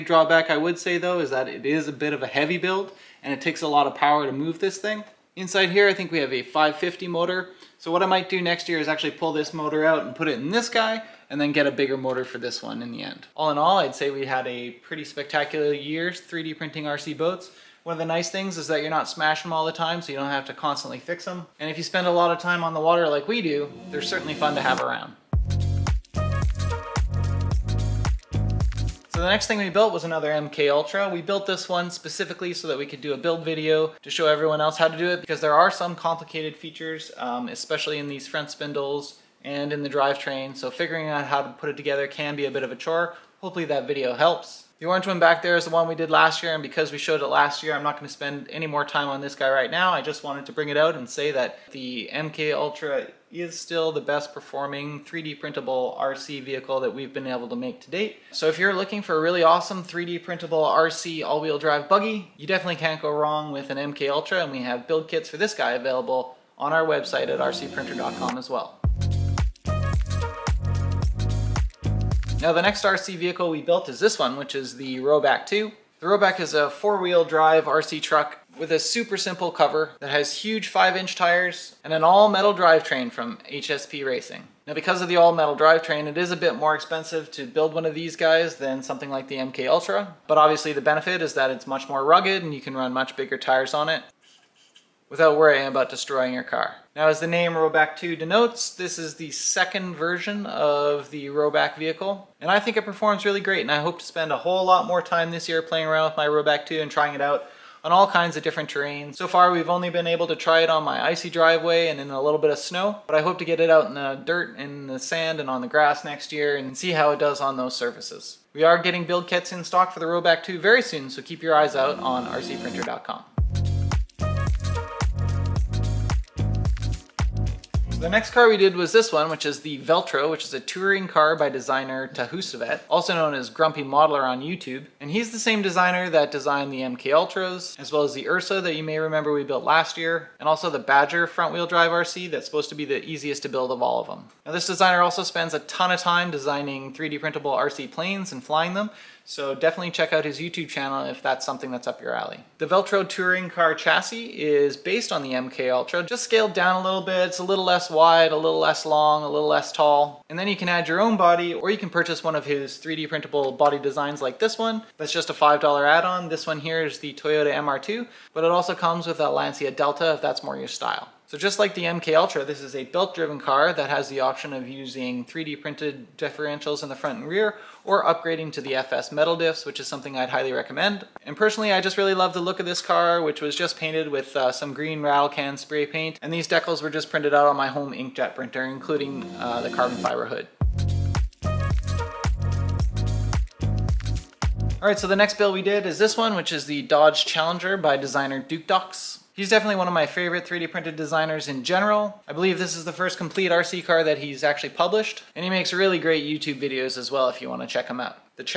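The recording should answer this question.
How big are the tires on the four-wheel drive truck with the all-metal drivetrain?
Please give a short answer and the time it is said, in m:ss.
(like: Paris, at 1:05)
5-inch, at 1:20.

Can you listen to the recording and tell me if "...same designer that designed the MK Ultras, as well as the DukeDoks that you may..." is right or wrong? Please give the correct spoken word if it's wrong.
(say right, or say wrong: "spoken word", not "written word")
wrong: "Ursa", not "DukeDoks".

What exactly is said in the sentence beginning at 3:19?
He's definitely one of my favorite 3D printed designers in general.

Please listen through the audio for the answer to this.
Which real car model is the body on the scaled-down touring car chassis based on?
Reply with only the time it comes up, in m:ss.
2:47.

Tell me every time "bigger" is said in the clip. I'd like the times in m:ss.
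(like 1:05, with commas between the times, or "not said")
0:11, 1:33.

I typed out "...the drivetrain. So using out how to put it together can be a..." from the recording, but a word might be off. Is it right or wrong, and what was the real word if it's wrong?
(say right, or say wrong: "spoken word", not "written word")
wrong: "figuring", not "using".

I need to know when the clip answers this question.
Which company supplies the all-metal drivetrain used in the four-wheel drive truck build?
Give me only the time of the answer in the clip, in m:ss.
1:23.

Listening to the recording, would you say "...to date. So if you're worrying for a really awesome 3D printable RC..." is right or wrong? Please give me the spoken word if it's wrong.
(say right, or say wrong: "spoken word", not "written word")
wrong: "looking", not "worrying".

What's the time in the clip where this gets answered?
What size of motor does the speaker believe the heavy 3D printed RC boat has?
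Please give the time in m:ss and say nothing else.
0:06.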